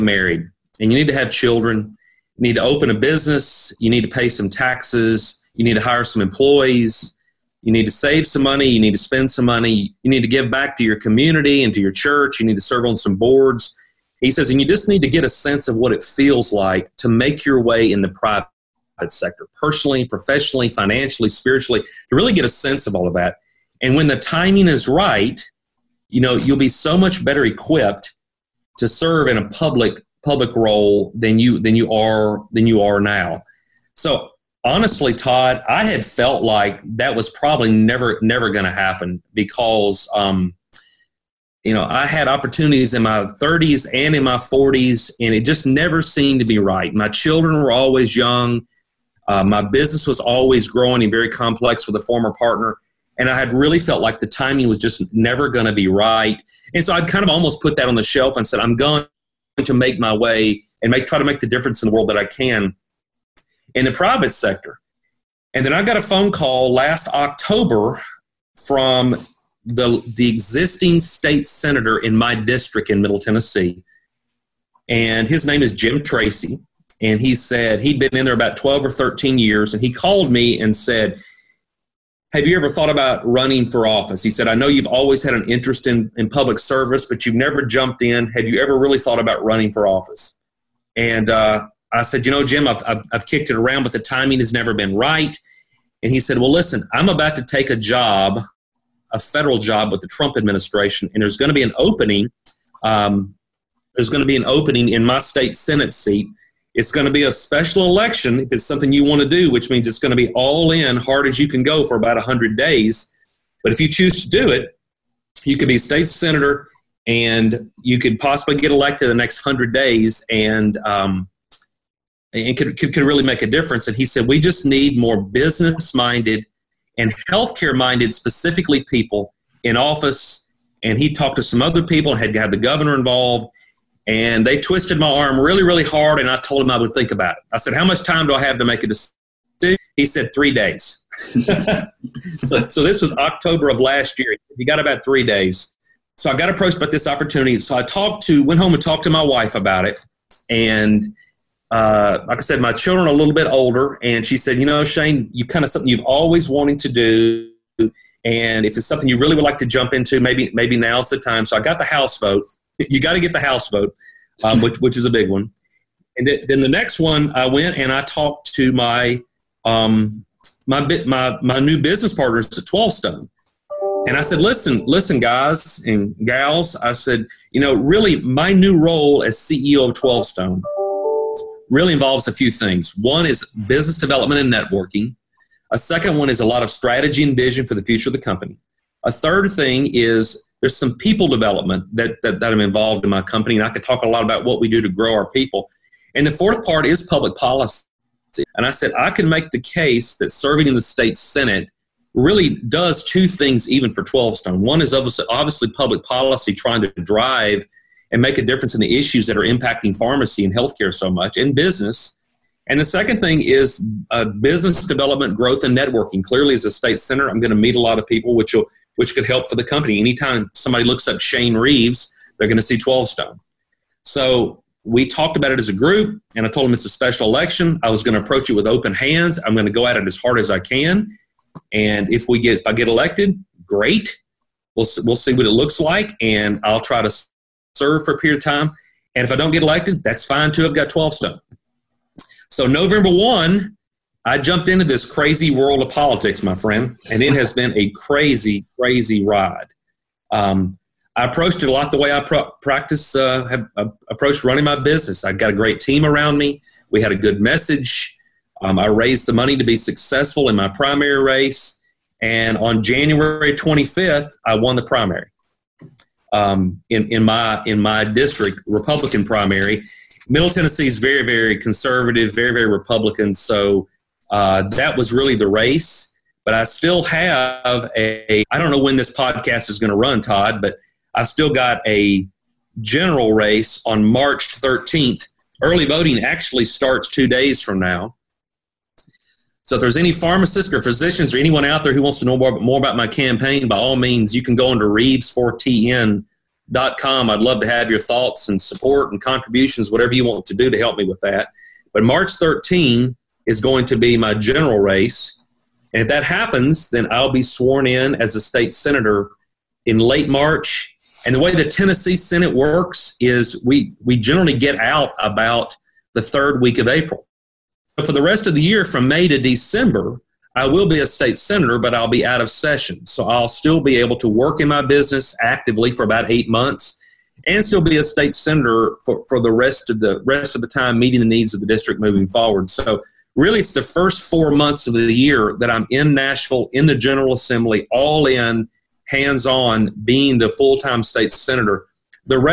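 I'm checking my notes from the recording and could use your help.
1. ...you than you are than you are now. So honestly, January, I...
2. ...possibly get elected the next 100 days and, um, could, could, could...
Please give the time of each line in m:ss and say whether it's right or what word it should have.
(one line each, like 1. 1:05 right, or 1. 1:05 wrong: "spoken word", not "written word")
1. 0:31 wrong: "Todd", not "January"
2. 1:58 right.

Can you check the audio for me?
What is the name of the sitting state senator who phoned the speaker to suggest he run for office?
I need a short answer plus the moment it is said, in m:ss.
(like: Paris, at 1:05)
Jim Tracy, at 1:15.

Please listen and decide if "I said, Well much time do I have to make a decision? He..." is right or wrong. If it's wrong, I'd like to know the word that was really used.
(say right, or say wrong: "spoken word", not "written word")
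wrong: "How", not "Well".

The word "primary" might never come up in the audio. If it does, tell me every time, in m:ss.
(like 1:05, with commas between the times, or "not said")
4:20, 4:24, 4:29.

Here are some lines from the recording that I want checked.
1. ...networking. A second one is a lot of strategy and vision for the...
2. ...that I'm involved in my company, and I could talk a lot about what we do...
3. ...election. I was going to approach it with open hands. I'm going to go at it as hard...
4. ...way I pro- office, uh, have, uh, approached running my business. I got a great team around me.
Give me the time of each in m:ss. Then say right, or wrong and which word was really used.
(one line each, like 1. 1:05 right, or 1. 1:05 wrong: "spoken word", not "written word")
1. 3:04 right
2. 3:12 right
3. 3:47 right
4. 4:11 wrong: "practice", not "office".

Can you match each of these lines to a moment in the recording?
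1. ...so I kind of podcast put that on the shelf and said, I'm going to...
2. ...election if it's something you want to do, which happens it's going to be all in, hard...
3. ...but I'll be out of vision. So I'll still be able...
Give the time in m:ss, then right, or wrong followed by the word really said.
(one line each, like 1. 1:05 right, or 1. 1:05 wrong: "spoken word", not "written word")
1. 0:56 wrong: "almost", not "podcast"
2. 1:47 wrong: "means", not "happens"
3. 5:21 wrong: "session", not "vision".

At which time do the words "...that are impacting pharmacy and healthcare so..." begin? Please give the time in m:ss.
3:29.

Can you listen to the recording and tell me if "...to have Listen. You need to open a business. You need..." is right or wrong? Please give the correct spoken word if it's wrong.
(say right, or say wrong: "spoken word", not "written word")
wrong: "children", not "Listen".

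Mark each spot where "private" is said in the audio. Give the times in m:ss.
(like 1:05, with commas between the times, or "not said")
0:18, 1:03.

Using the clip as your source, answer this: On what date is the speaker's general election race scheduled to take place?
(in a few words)
March 13th.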